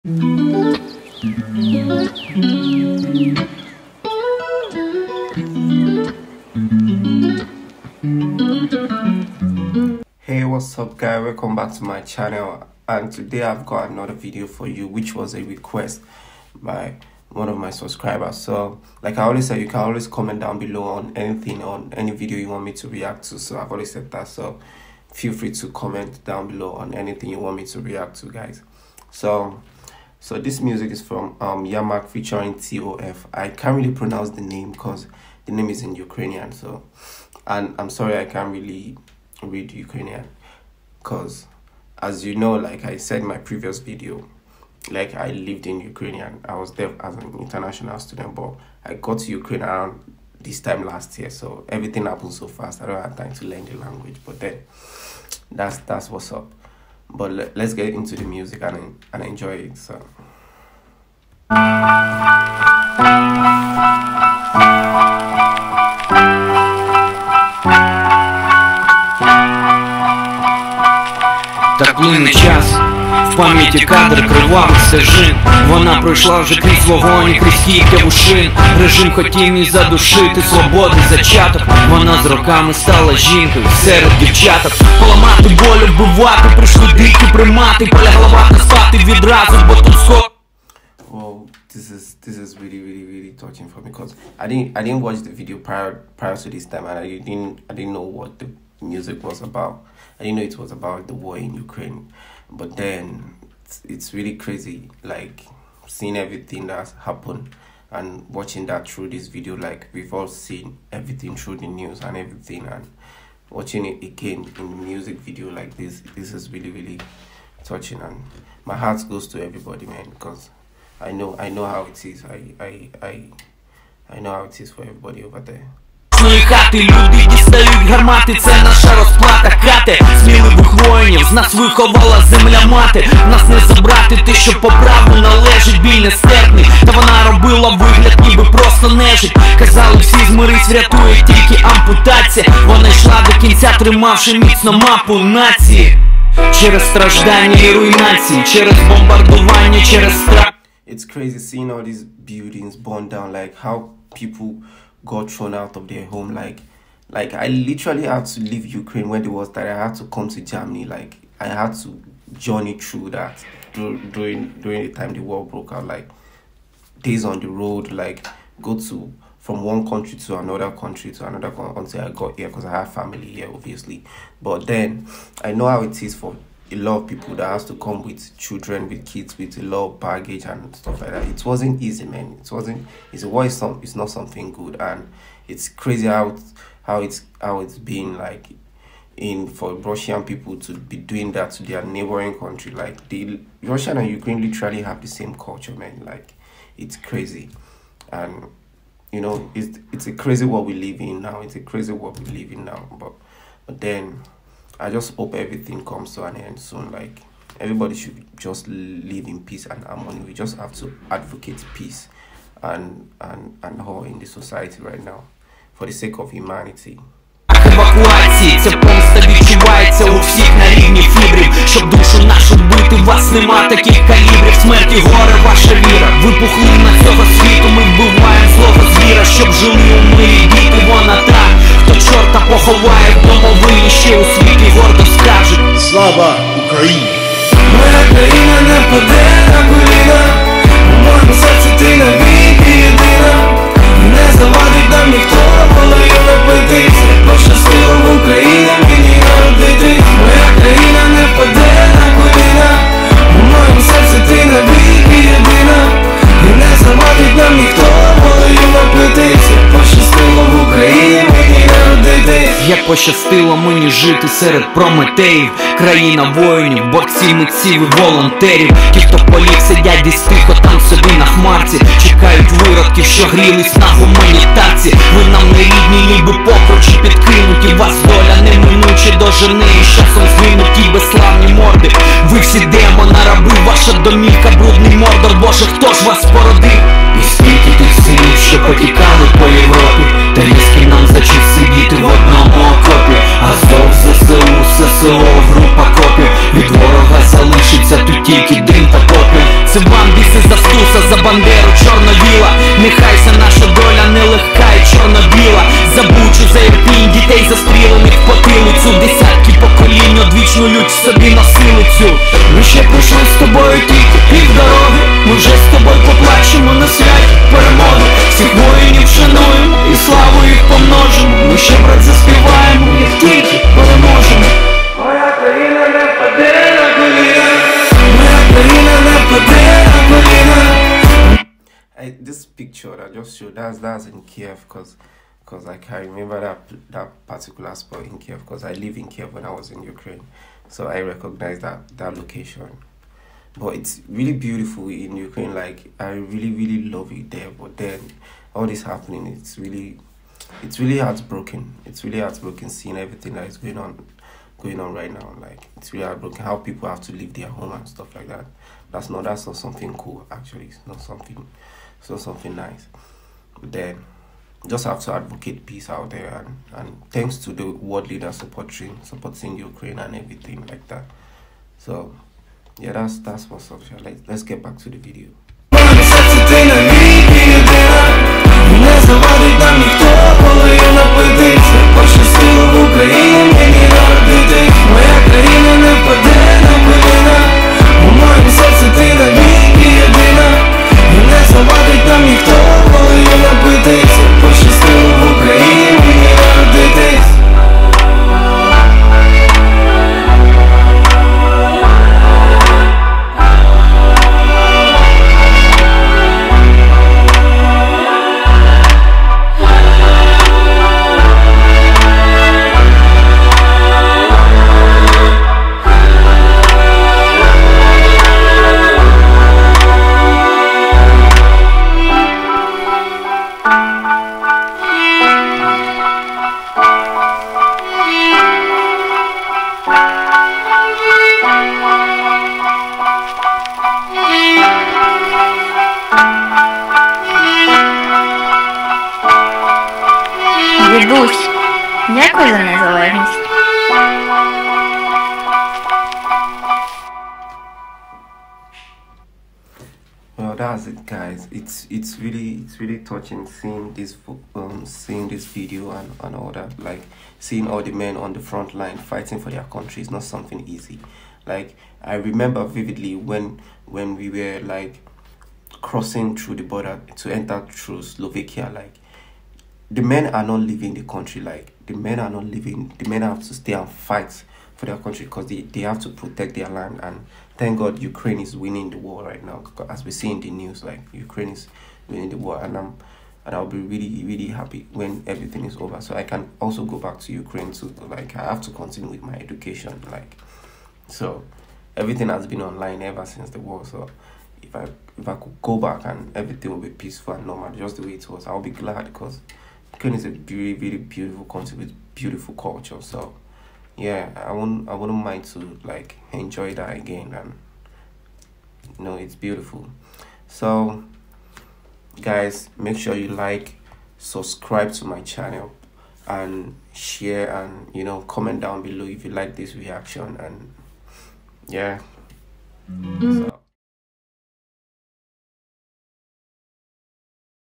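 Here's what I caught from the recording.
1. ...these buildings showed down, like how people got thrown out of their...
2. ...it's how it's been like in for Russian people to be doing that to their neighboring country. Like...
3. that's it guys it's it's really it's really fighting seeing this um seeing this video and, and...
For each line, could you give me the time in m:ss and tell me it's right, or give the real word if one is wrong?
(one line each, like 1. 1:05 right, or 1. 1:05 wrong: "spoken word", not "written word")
1. 2:31 wrong: "burned", not "showed"
2. 3:07 right
3. 7:30 wrong: "touching", not "fighting".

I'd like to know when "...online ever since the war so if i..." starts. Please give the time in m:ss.
8:12.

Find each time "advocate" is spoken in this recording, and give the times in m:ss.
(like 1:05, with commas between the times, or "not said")
3:31, 6:05.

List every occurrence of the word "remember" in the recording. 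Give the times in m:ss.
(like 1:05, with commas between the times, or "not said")
5:36, 7:42.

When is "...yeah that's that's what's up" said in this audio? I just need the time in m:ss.
6:12.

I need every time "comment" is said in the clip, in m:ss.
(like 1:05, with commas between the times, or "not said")
0:20, 0:25, 8:38.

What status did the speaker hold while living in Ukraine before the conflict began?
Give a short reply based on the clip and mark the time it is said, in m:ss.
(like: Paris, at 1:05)
international student, at 0:47.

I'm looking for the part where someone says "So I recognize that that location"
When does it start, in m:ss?
5:40.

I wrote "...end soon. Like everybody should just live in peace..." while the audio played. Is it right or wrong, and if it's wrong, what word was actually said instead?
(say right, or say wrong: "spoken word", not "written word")
right.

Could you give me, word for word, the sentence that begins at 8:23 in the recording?
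So yeah, I won't I wouldn't mind to like enjoy that again and you know it's beautiful.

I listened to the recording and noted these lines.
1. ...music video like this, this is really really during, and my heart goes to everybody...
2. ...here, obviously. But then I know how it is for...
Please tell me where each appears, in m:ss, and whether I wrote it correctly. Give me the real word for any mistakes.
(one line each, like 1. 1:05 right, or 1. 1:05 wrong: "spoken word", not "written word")
1. 1:54 wrong: "touching", not "during"
2. 2:53 right.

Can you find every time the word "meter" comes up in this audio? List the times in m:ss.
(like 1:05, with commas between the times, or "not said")
not said.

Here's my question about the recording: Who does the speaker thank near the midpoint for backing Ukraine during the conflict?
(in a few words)
world leaders.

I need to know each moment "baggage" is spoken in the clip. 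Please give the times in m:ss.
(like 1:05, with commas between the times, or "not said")
2:59.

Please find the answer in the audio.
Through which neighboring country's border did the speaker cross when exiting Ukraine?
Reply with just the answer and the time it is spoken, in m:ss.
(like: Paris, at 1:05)
Slovakia, at 7:48.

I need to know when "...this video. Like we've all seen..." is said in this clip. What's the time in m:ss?
1:49.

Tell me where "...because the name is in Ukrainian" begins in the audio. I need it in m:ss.
0:34.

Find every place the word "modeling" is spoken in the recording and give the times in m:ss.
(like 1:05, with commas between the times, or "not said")
not said.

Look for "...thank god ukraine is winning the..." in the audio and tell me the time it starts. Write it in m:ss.
7:57.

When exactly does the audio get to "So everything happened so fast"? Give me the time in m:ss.
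0:51.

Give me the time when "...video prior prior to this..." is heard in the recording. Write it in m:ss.
1:35.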